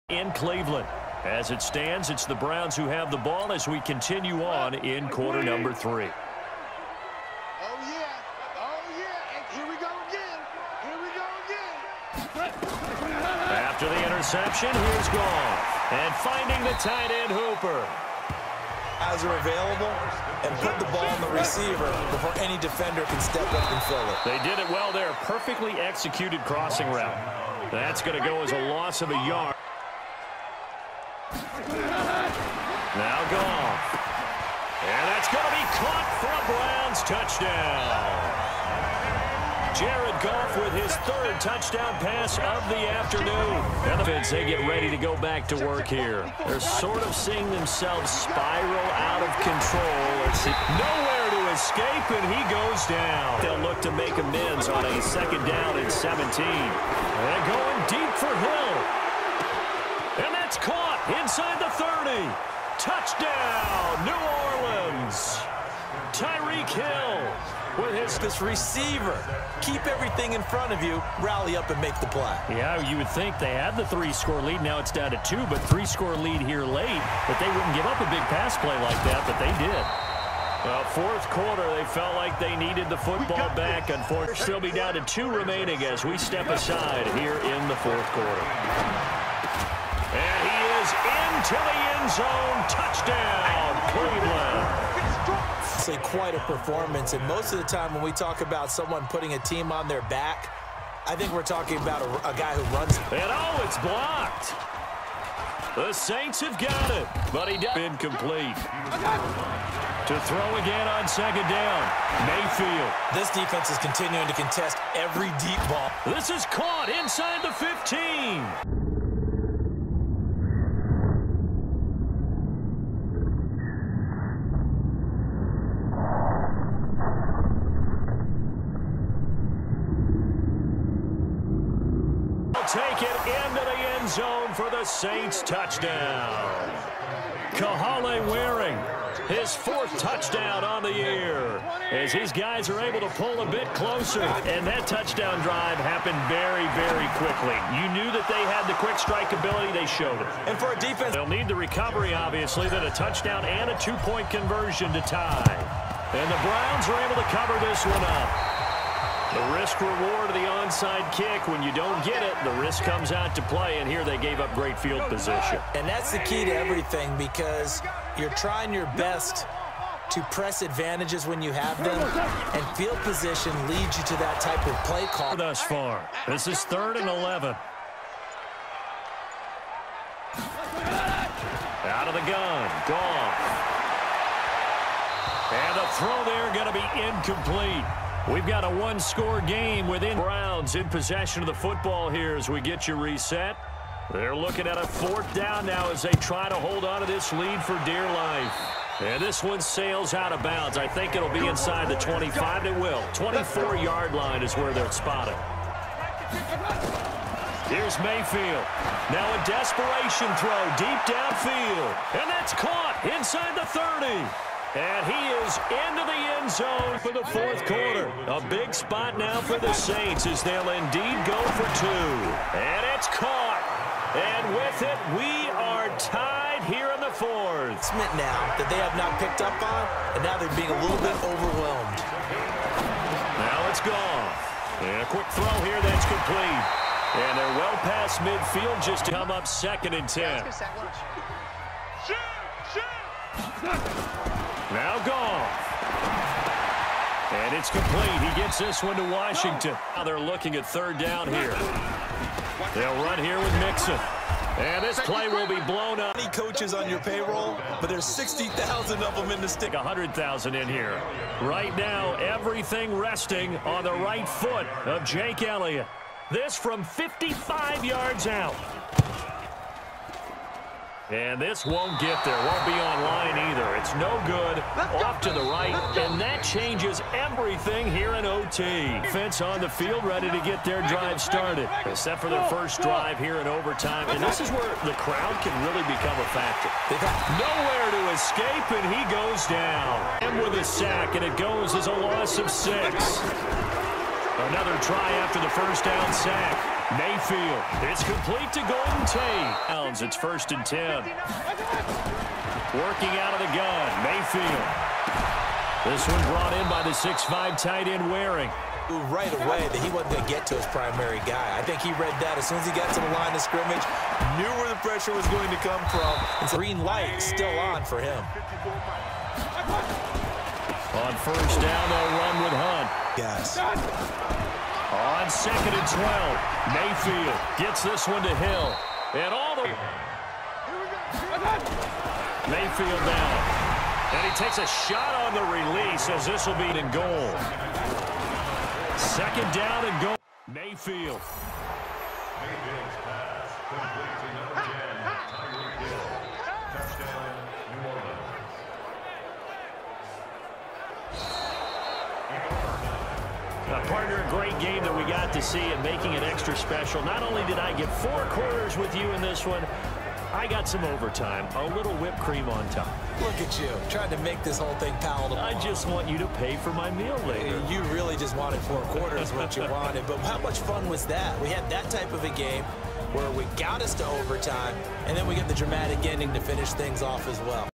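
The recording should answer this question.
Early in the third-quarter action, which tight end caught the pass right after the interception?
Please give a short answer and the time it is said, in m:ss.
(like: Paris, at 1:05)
Hooper, at 0:17.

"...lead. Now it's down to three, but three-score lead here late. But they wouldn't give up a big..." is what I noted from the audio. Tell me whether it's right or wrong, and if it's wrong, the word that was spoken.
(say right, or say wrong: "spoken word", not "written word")
wrong: "two", not "three".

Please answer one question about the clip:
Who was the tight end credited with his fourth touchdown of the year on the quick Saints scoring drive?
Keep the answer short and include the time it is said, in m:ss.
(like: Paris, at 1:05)
Kahale Warring, at 2:17.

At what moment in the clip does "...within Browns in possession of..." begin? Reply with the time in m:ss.
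3:09.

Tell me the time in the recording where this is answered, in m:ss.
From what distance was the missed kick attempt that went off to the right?
4:26.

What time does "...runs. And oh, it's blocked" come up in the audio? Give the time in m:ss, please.
1:42.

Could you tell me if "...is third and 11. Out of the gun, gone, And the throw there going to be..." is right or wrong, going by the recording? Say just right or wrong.
right.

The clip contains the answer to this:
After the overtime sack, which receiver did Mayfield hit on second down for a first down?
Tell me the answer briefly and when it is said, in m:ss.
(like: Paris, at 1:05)
Golden Tate, at 4:58.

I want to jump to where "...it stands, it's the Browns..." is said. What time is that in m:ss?
0:01.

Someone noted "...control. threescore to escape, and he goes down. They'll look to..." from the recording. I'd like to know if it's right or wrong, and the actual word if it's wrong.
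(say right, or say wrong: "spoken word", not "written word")
wrong: "nowhere", not "threescore".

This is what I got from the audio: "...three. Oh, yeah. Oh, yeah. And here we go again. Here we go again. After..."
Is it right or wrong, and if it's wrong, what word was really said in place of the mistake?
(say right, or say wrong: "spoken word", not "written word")
right.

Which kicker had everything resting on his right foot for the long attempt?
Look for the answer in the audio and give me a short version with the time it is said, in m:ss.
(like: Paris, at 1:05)
Jake Elliott, at 4:25.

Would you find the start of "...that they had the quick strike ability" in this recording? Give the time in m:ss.
2:28.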